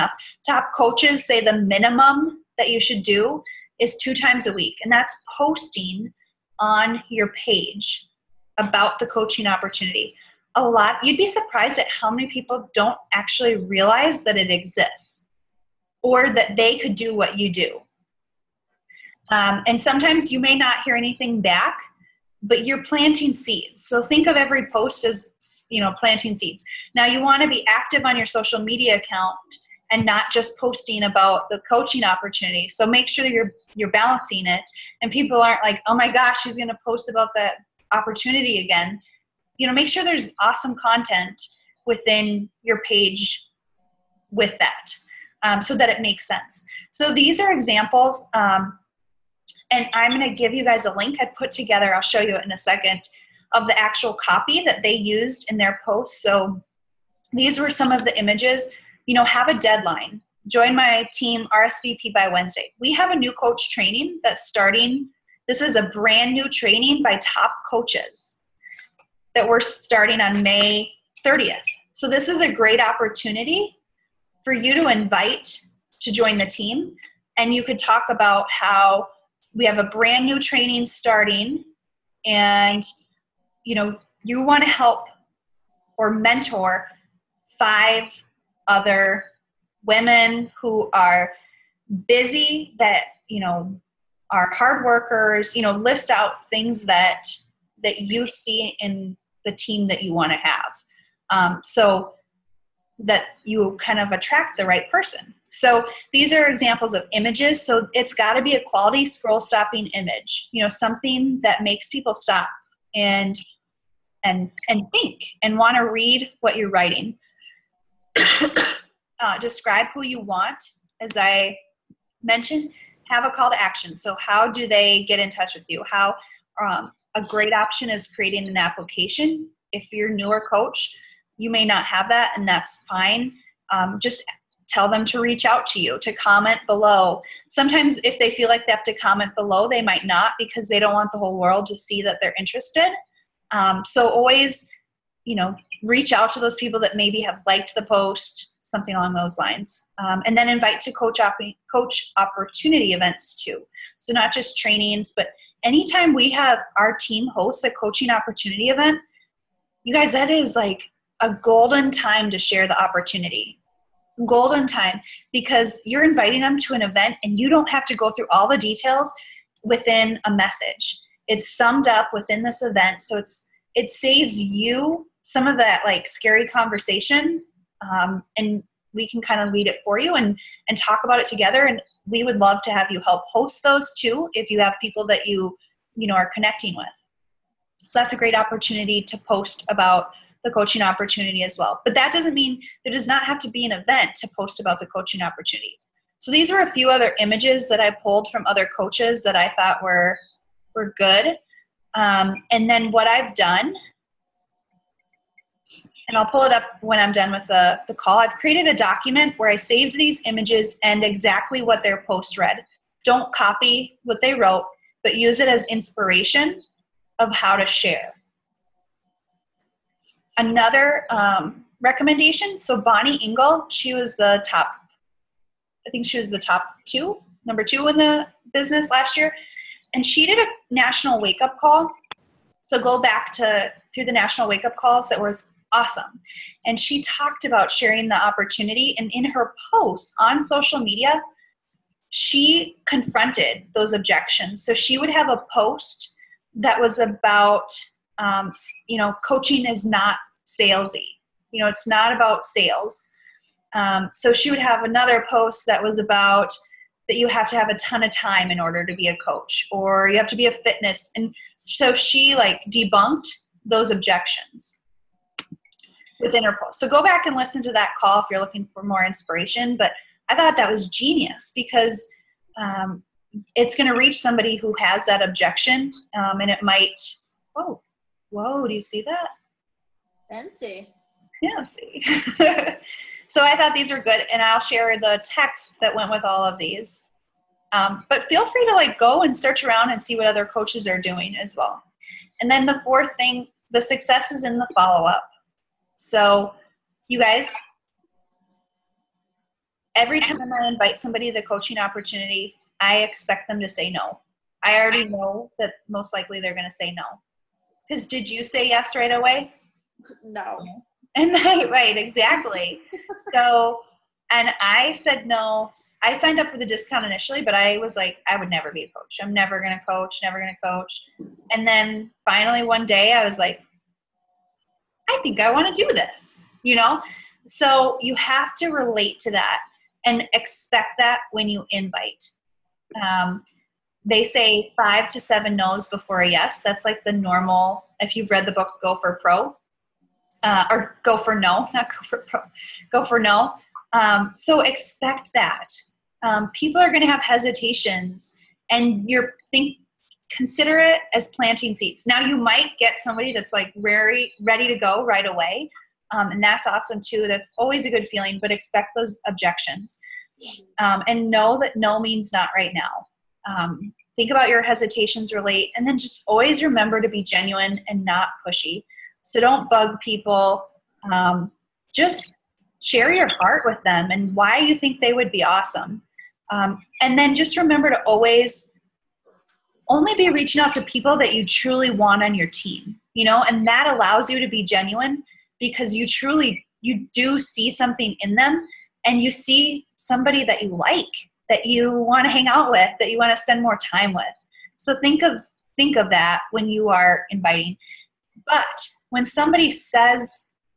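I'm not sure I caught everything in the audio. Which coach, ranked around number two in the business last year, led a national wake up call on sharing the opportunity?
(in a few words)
Bonnie Ingle.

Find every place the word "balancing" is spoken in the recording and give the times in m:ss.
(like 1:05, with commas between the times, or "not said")
0:33.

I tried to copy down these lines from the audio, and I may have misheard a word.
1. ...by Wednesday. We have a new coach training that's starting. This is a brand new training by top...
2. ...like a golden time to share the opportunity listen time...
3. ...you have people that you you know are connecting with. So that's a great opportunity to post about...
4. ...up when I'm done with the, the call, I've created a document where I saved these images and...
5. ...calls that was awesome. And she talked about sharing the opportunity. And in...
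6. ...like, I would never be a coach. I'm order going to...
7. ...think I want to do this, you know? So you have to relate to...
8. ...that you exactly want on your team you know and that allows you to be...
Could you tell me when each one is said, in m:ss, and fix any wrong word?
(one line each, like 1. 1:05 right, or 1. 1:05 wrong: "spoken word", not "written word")
1. 1:02 right
2. 2:40 wrong: "golden", not "listen"
3. 3:04 right
4. 3:26 right
5. 3:54 right
6. 5:17 wrong: "never", not "order"
7. 5:25 right
8. 6:21 wrong: "truly", not "exactly".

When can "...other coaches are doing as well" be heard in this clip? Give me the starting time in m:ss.
4:50.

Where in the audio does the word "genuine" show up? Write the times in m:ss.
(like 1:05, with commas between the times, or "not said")
6:07, 6:24.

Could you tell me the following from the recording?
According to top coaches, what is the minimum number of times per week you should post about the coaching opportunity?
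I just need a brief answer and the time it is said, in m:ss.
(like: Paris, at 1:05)
2, at 0:03.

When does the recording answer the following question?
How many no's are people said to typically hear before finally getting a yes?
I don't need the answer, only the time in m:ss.
5:34.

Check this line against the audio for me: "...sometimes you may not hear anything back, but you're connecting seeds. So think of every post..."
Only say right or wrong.
wrong.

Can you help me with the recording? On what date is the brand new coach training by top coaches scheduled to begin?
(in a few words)
May 30th.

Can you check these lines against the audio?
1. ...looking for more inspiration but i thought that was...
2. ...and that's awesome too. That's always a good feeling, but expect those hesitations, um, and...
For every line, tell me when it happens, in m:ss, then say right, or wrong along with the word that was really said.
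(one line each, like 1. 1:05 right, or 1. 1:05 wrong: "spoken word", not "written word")
1. 4:28 right
2. 5:56 wrong: "objections", not "hesitations".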